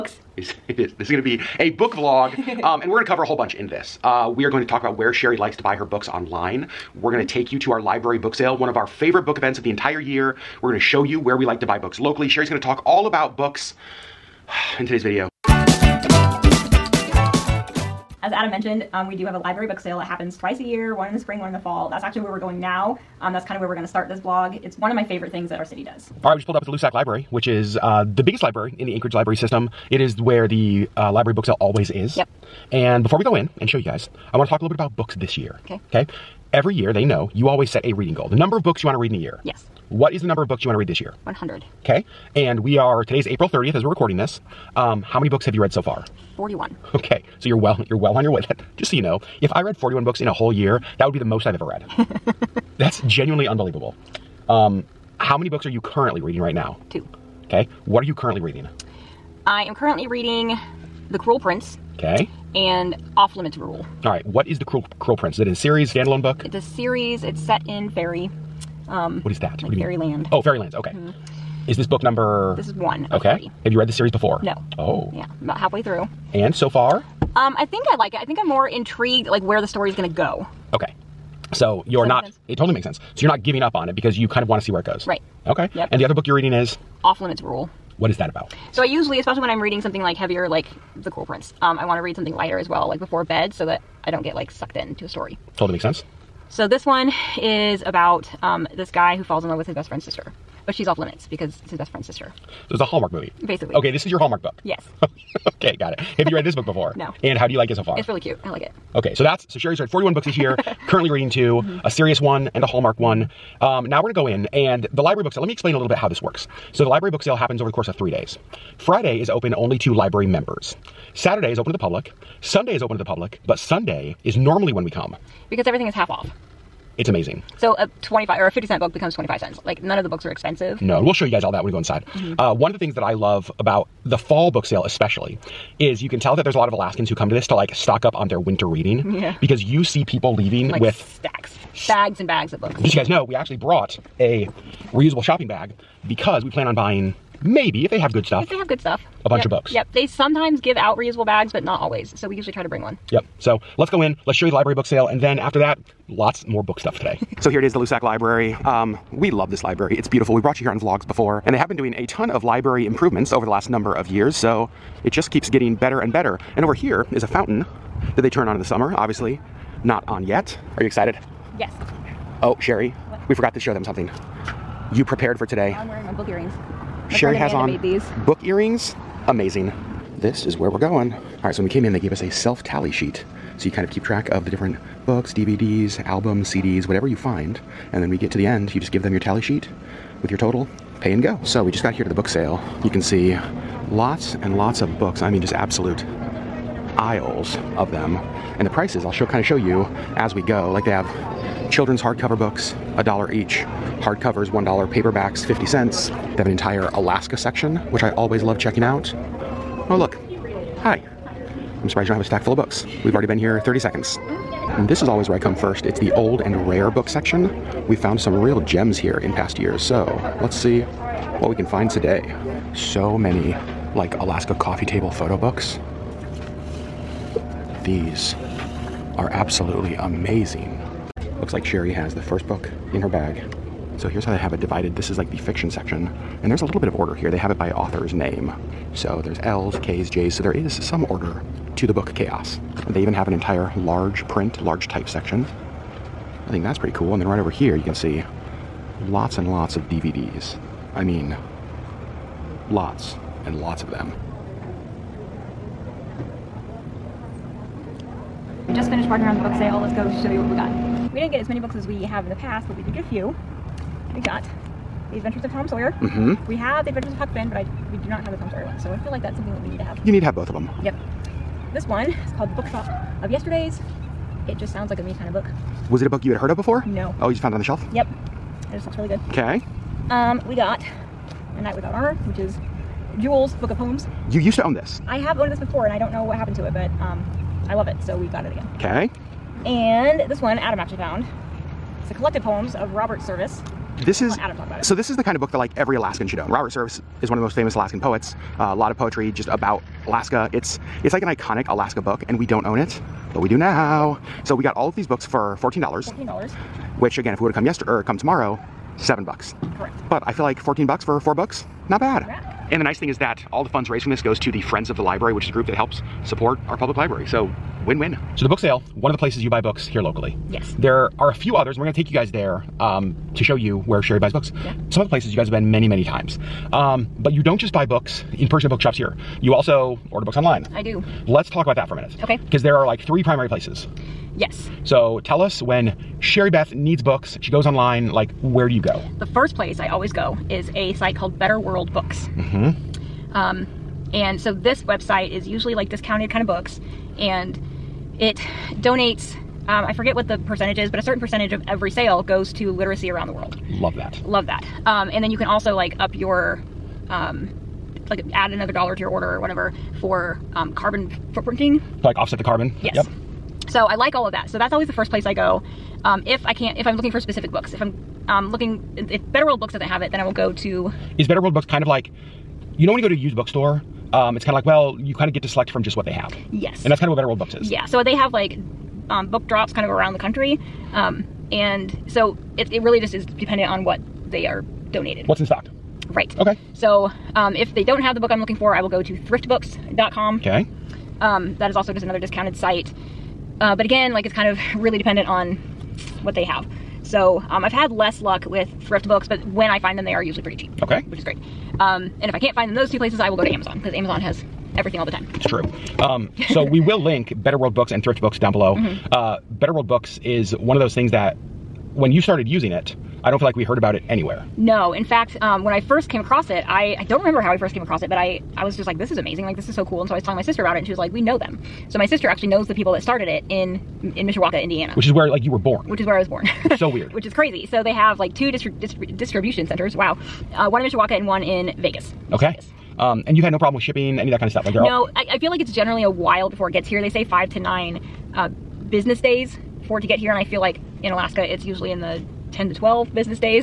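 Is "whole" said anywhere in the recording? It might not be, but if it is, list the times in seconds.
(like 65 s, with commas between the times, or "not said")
3 s, 50 s.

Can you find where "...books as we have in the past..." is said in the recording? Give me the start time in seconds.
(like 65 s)
261 s.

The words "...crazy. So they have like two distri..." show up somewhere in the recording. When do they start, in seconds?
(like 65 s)
427 s.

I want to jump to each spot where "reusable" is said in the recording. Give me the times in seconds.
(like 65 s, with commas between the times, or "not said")
144 s, 150 s.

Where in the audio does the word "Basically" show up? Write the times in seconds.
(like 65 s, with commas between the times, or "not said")
103 s.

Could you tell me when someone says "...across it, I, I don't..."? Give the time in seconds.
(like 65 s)
416 s.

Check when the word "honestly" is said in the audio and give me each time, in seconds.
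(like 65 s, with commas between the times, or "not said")
not said.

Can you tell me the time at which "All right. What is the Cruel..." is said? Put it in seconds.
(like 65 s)
64 s.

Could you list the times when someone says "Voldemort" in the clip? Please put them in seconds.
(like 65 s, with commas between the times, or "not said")
not said.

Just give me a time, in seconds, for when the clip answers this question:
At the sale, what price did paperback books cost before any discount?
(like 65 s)
204 s.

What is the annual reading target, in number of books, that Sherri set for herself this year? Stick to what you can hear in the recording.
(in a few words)
100.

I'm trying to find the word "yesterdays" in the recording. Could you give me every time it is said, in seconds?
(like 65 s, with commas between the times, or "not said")
273 s, 307 s.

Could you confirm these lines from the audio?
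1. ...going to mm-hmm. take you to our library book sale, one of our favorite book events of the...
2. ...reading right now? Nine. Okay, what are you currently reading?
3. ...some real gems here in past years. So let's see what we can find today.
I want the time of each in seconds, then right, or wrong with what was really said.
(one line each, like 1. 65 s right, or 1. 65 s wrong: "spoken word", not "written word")
1. 7 s right
2. 56 s wrong: "Two", not "Nine"
3. 218 s right.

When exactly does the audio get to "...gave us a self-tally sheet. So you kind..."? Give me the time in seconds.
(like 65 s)
181 s.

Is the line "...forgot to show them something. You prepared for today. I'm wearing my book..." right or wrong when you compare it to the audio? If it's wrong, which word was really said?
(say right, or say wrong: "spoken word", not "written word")
right.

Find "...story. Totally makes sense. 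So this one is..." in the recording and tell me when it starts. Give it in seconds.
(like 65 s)
95 s.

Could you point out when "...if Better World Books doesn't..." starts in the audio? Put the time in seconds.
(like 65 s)
369 s.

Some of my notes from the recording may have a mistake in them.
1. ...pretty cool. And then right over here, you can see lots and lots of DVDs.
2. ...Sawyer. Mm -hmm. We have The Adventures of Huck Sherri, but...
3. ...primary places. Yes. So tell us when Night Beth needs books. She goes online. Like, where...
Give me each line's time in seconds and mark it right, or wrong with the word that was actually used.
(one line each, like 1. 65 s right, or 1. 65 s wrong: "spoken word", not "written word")
1. 246 s right
2. 265 s wrong: "Finn", not "Sherri"
3. 333 s wrong: "Sherri", not "Night".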